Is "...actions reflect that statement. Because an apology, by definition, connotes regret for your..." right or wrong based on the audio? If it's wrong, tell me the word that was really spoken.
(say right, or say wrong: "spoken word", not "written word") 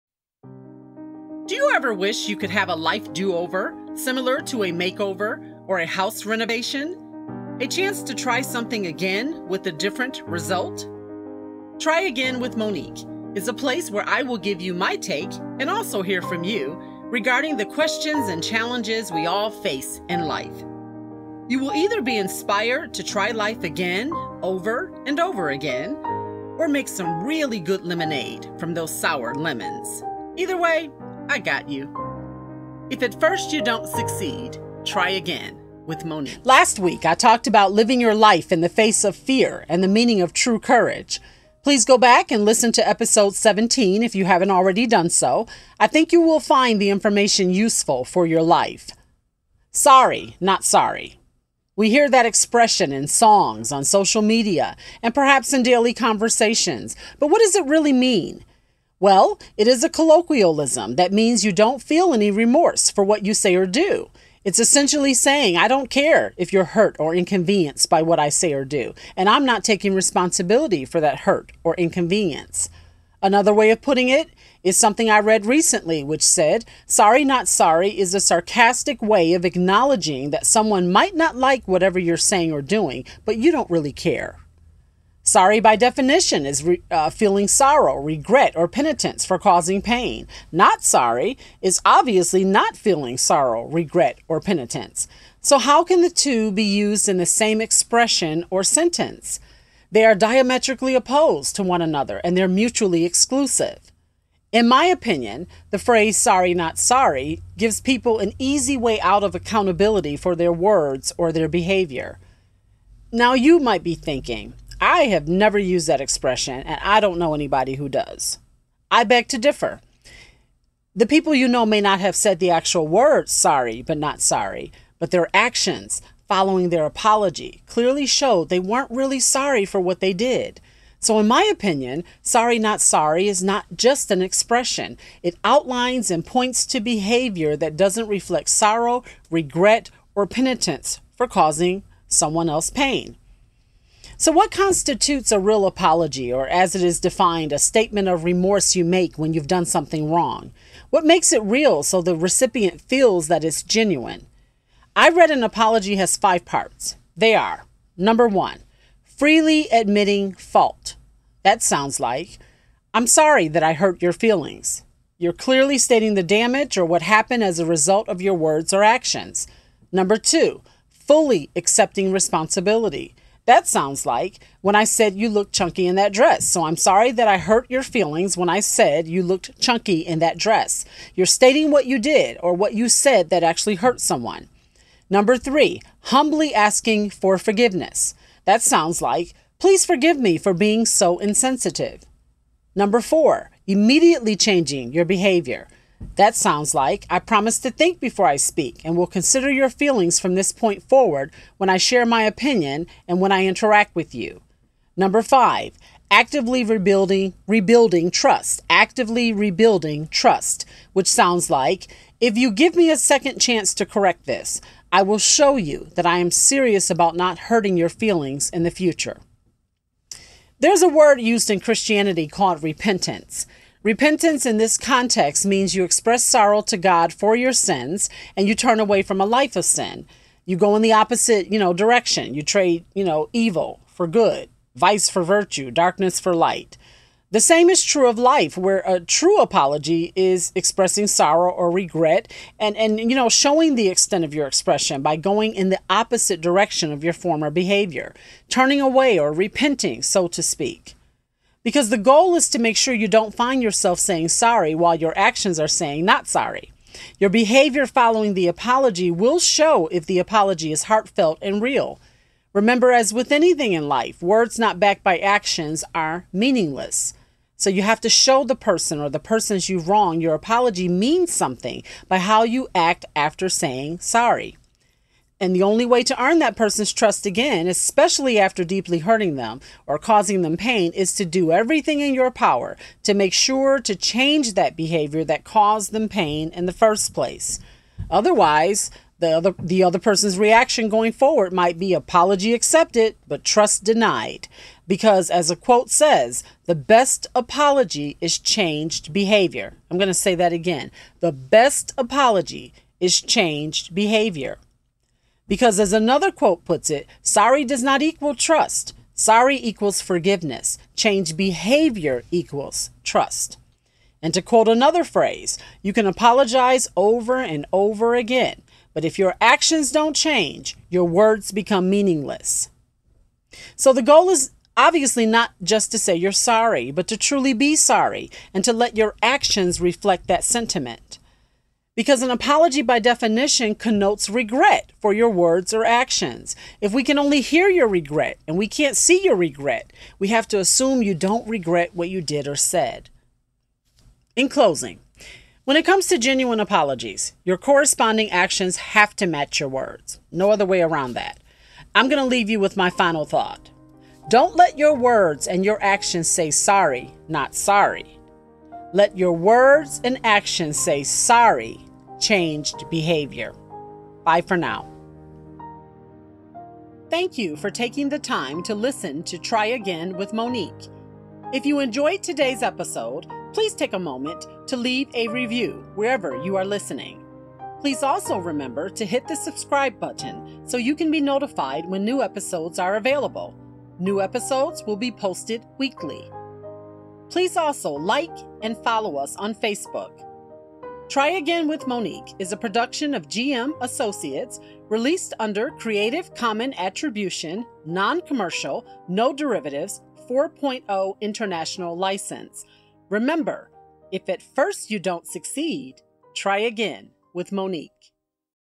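wrong: "sentiment", not "statement".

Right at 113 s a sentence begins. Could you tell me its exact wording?
Now, you might be thinking, I have never used that expression, and I don't know anybody who does.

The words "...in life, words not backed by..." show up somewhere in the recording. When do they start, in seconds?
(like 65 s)
263 s.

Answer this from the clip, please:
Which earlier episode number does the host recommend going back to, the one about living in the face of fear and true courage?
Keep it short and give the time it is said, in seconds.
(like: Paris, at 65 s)
17, at 42 s.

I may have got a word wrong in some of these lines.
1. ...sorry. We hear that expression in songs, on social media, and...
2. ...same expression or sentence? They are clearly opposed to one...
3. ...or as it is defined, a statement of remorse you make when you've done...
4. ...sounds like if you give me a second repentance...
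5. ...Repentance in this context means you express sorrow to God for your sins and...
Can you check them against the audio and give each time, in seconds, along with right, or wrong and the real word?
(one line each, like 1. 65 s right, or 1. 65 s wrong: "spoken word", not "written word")
1. 50 s right
2. 97 s wrong: "diametrically", not "clearly"
3. 146 s right
4. 211 s wrong: "chance", not "repentance"
5. 223 s right.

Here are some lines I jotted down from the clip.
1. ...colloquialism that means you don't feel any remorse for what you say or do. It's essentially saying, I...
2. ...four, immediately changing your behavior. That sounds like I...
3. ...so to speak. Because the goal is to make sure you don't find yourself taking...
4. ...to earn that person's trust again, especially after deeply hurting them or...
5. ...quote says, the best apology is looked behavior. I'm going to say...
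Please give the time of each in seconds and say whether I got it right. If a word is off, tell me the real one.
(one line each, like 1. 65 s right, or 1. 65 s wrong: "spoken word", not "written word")
1. 59 s right
2. 193 s right
3. 250 s wrong: "saying", not "taking"
4. 276 s right
5. 295 s wrong: "changed", not "looked".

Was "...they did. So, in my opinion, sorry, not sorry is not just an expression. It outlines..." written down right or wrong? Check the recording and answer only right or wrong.
right.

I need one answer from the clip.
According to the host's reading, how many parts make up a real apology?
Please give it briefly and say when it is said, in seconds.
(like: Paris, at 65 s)
5, at 156 s.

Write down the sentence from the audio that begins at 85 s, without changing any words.
Sorry, by definition, is re- uh, feeling sorrow, regret, or penitence for causing pain.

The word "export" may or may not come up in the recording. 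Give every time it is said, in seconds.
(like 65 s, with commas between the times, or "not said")
not said.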